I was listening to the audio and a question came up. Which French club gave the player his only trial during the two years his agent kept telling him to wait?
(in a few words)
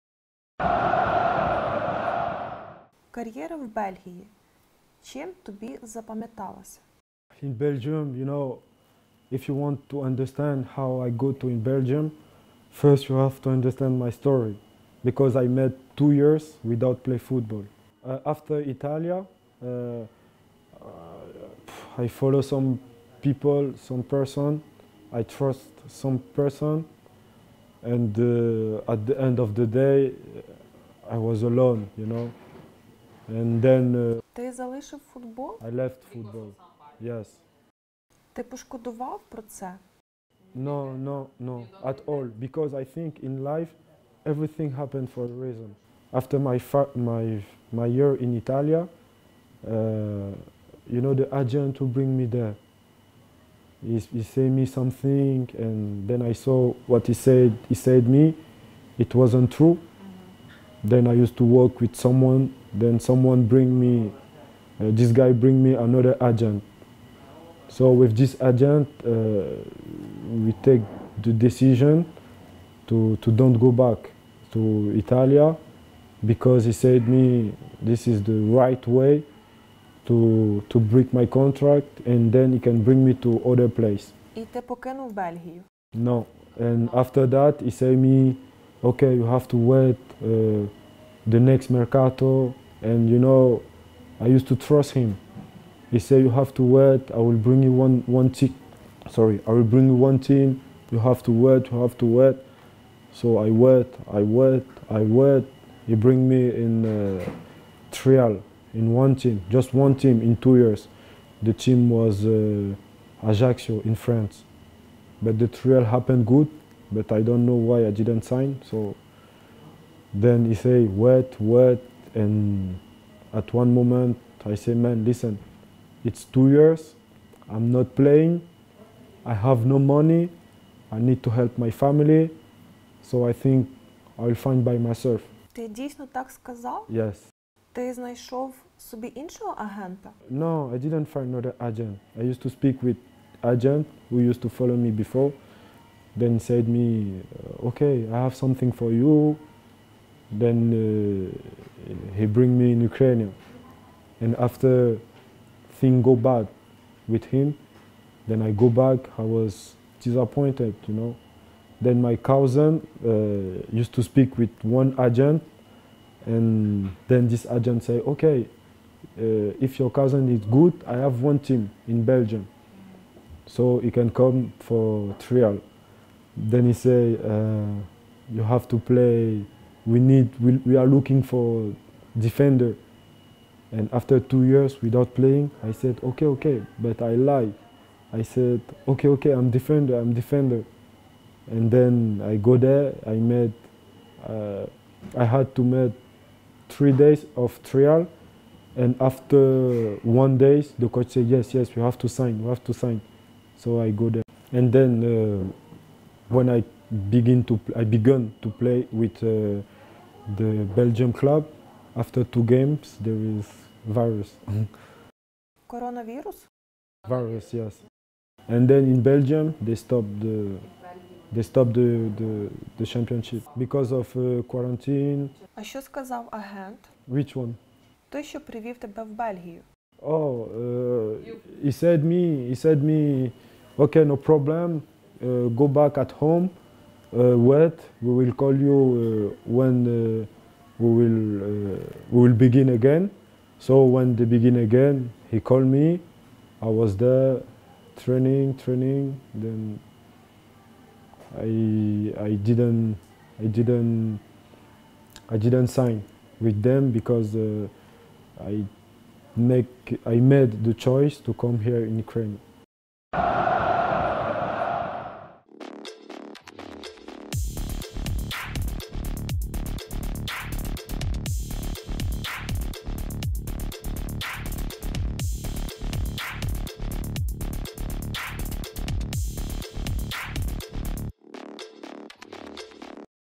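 Ajaccio.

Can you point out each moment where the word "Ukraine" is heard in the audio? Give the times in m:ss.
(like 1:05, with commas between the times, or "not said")
2:32, 4:21.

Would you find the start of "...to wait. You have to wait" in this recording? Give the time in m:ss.
1:41.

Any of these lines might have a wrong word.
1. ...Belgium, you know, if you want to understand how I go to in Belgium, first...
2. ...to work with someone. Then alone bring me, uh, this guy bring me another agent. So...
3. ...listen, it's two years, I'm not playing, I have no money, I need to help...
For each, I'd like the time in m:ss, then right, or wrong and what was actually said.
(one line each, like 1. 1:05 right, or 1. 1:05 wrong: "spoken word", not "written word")
1. 0:07 right
2. 1:01 wrong: "someone", not "alone"
3. 2:05 right.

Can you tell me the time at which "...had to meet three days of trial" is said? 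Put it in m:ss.
3:15.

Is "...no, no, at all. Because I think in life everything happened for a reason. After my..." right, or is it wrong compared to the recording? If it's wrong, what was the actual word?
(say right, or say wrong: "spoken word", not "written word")
right.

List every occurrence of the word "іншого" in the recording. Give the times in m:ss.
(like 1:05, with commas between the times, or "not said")
2:19.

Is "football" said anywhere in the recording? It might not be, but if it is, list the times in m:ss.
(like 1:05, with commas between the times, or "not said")
0:17, 0:36.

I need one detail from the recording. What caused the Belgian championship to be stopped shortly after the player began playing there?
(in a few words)
Coronavirus.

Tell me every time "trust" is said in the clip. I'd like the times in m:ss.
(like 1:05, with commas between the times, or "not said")
0:25, 1:34.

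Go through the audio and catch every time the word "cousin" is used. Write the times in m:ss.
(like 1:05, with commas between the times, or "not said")
2:42, 2:49.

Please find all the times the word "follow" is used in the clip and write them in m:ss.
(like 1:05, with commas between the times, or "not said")
0:22, 2:24.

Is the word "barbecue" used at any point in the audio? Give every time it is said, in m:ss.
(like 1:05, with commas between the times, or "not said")
not said.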